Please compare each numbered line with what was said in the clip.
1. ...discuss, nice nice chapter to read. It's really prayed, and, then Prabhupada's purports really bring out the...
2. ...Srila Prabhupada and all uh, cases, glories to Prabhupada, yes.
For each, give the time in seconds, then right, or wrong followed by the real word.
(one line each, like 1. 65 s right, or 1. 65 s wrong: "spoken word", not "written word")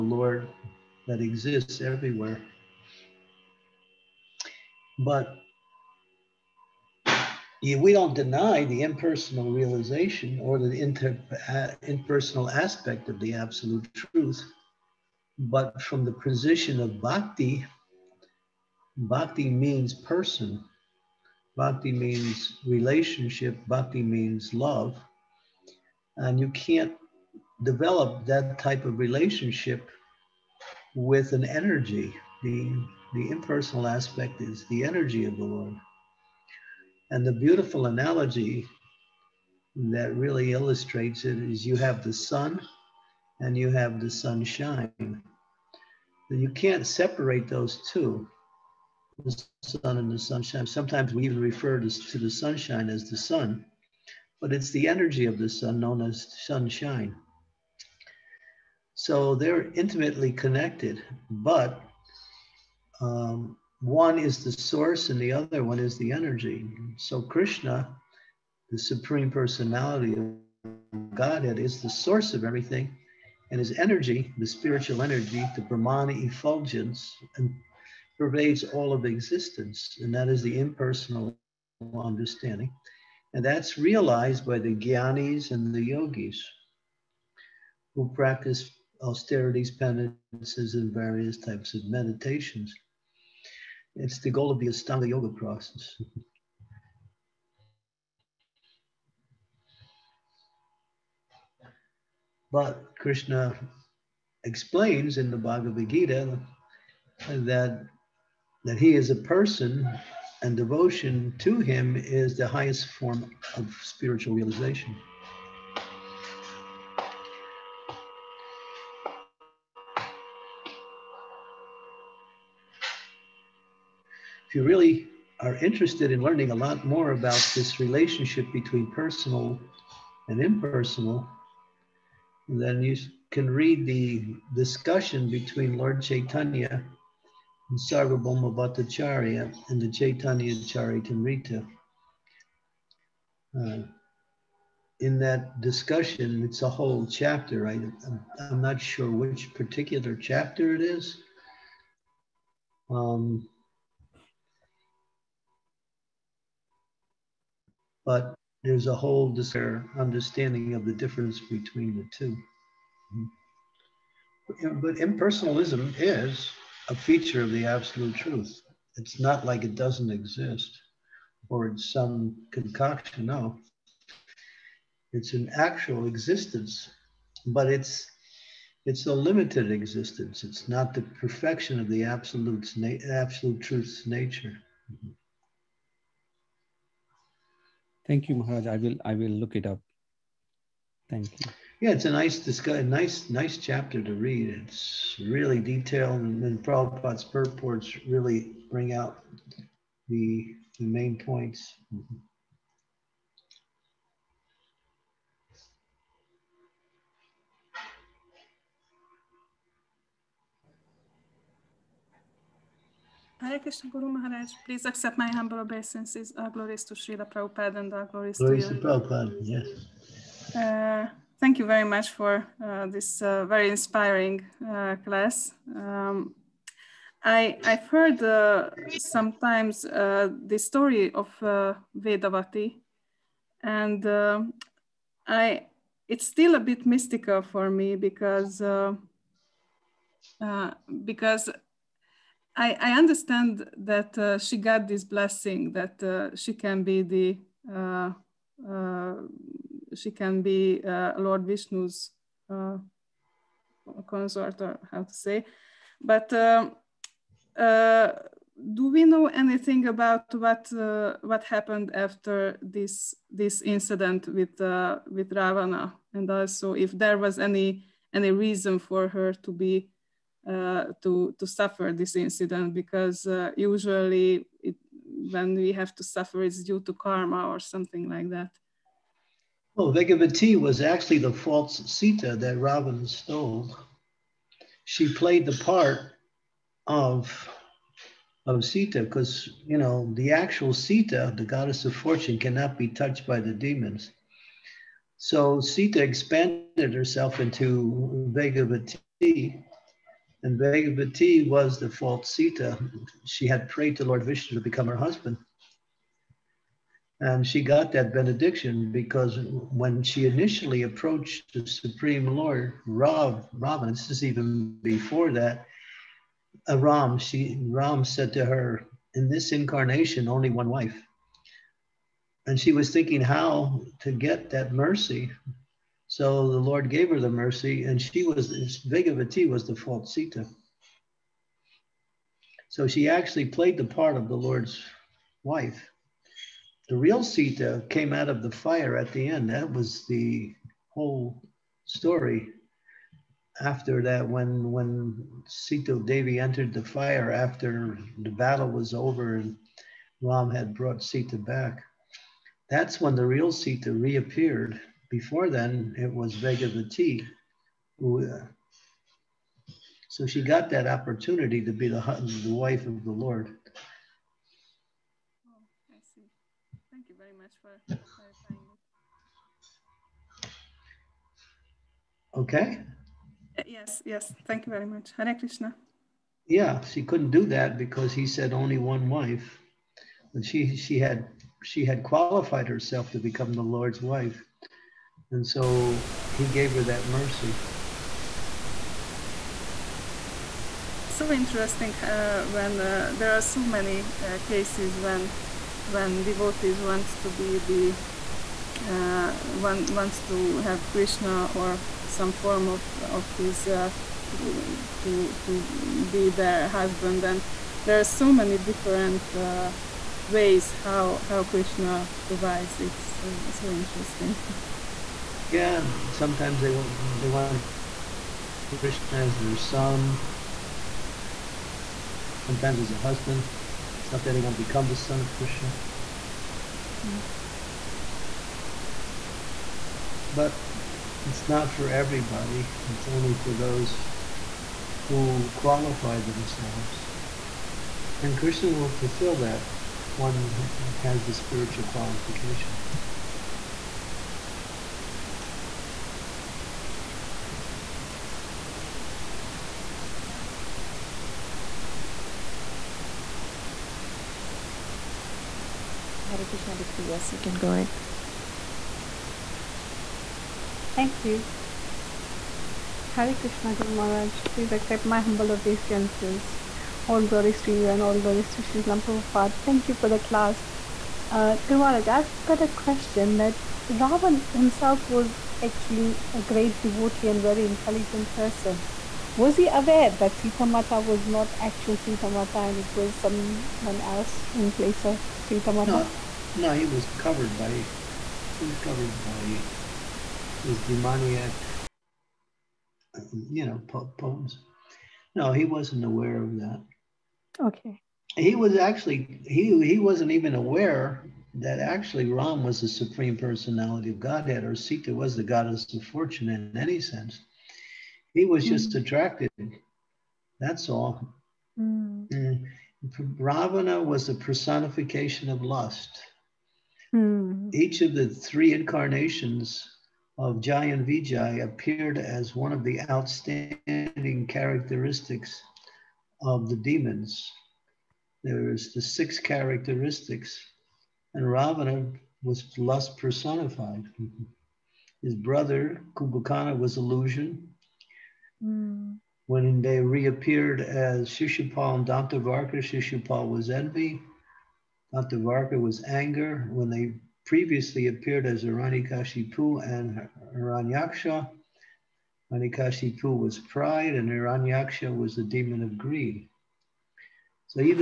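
1. 192 s wrong: "detailed", not "prayed"
2. 216 s wrong: "glories", not "cases".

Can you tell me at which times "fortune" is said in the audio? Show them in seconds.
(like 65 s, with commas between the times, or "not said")
291 s, 506 s.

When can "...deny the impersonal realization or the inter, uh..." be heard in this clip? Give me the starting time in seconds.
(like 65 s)
8 s.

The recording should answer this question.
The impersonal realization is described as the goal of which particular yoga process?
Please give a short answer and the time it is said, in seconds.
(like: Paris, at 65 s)
Ashtanga Yoga, at 94 s.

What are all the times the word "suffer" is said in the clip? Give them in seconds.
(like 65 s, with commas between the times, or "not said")
271 s, 276 s.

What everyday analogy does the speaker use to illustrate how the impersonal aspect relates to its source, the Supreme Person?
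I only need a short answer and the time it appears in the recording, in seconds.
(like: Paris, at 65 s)
The sun and the sunshine, at 49 s.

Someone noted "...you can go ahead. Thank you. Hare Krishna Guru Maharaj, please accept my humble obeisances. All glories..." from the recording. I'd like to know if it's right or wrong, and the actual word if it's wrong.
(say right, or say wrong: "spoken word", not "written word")
right.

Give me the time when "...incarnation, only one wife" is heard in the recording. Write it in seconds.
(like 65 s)
319 s.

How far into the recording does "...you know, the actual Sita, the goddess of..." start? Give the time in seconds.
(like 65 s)
289 s.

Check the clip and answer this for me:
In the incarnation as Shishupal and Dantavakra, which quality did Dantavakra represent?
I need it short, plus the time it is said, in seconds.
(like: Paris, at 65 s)
Anger, at 546 s.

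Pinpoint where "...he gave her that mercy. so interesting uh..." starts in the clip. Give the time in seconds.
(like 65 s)
386 s.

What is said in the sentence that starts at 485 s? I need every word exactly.
No, no, he was covered by he was covered by his demoniac, you know, po- poems.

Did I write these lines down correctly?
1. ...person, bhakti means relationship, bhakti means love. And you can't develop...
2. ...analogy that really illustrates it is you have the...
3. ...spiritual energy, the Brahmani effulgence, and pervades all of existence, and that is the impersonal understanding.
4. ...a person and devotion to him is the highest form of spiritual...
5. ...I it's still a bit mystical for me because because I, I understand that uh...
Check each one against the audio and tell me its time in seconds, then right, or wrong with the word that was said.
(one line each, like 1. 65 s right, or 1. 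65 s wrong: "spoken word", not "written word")
1. 19 s right
2. 37 s right
3. 74 s right
4. 109 s right
5. 235 s right.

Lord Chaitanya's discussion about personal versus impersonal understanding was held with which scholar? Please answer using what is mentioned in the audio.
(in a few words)
Sarvabhauma Bhattacharya.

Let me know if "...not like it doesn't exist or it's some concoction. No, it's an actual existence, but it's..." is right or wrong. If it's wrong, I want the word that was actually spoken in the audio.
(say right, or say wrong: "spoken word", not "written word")
right.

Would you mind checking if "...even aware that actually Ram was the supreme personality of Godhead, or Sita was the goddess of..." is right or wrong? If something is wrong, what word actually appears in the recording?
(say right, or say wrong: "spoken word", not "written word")
right.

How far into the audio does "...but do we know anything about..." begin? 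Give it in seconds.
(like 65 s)
256 s.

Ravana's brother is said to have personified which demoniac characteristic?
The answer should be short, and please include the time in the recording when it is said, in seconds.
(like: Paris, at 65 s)
Illusion, at 536 s.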